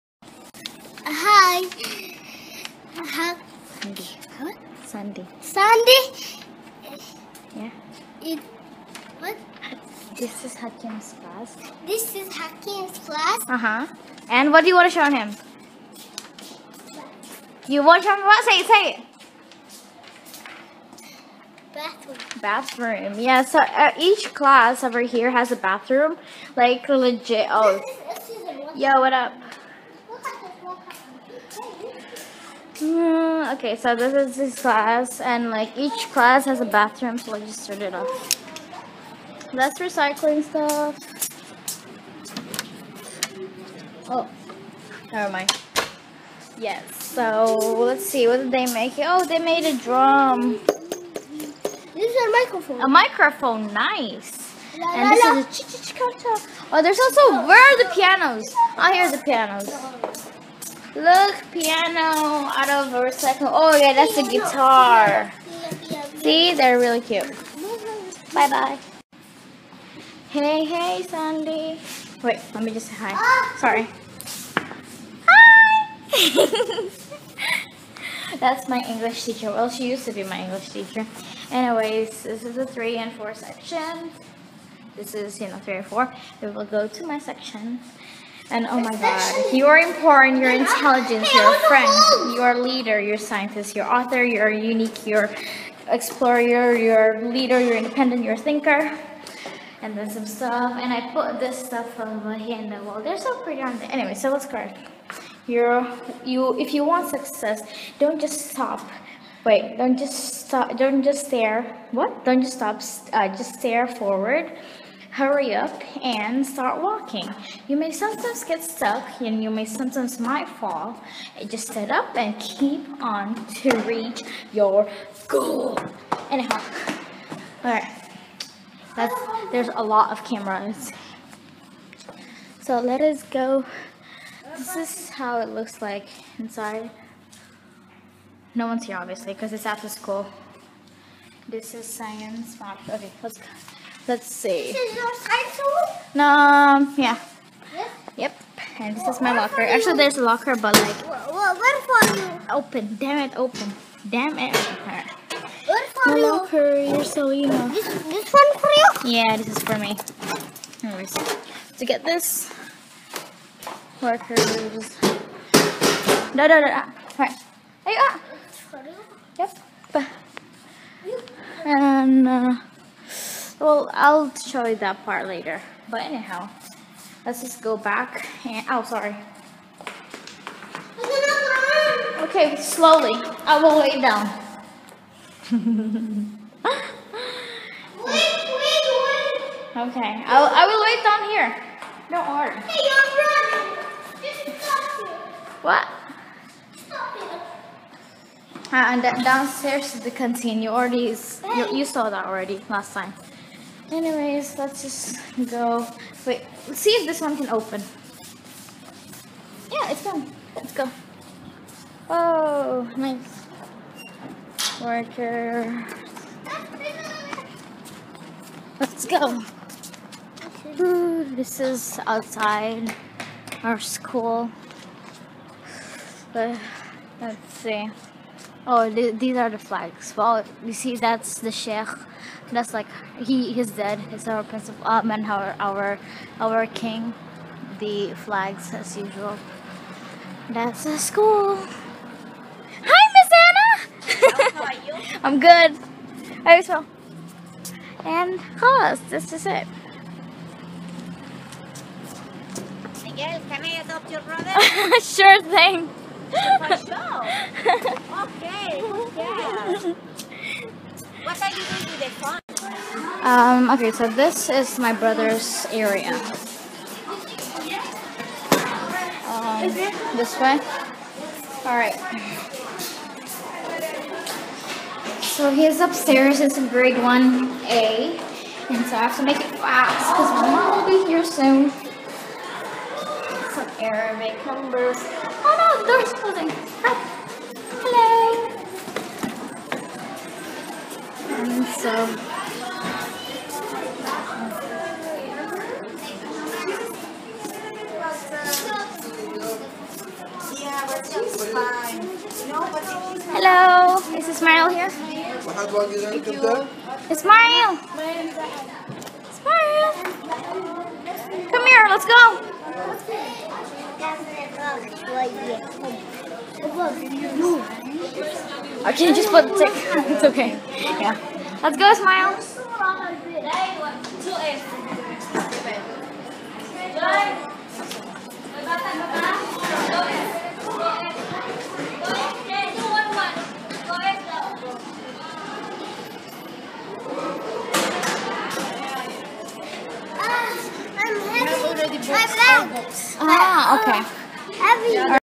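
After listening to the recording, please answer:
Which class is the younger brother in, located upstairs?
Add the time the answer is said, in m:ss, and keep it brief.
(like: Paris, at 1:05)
Grade 1A, at 4:36.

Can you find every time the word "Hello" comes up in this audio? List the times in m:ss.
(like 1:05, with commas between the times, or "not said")
4:47, 5:03.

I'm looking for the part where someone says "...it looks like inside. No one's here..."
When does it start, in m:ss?
2:15.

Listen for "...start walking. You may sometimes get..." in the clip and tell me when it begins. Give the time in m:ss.
1:56.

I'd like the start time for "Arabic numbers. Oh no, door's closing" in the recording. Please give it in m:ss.
4:43.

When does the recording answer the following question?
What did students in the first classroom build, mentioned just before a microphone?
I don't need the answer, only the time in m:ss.
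0:49.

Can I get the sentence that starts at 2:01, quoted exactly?
Just sit up and keep on to reach your goal.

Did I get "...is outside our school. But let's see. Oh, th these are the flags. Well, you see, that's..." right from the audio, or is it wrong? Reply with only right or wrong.
right.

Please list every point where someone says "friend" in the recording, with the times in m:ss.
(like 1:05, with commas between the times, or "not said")
1:31.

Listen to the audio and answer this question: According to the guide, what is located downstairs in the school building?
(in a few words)
The canteen.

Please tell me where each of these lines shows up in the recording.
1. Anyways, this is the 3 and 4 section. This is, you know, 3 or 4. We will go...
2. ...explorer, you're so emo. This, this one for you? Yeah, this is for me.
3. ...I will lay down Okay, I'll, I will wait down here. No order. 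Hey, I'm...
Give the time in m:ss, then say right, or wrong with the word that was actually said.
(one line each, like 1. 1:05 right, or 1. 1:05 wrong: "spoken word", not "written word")
1. 1:21 right
2. 2:36 wrong: "locker", not "explorer"
3. 3:03 right.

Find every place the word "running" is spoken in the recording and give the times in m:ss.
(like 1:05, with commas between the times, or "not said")
3:13.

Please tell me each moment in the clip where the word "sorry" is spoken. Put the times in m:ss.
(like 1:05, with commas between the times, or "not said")
1:13, 2:58.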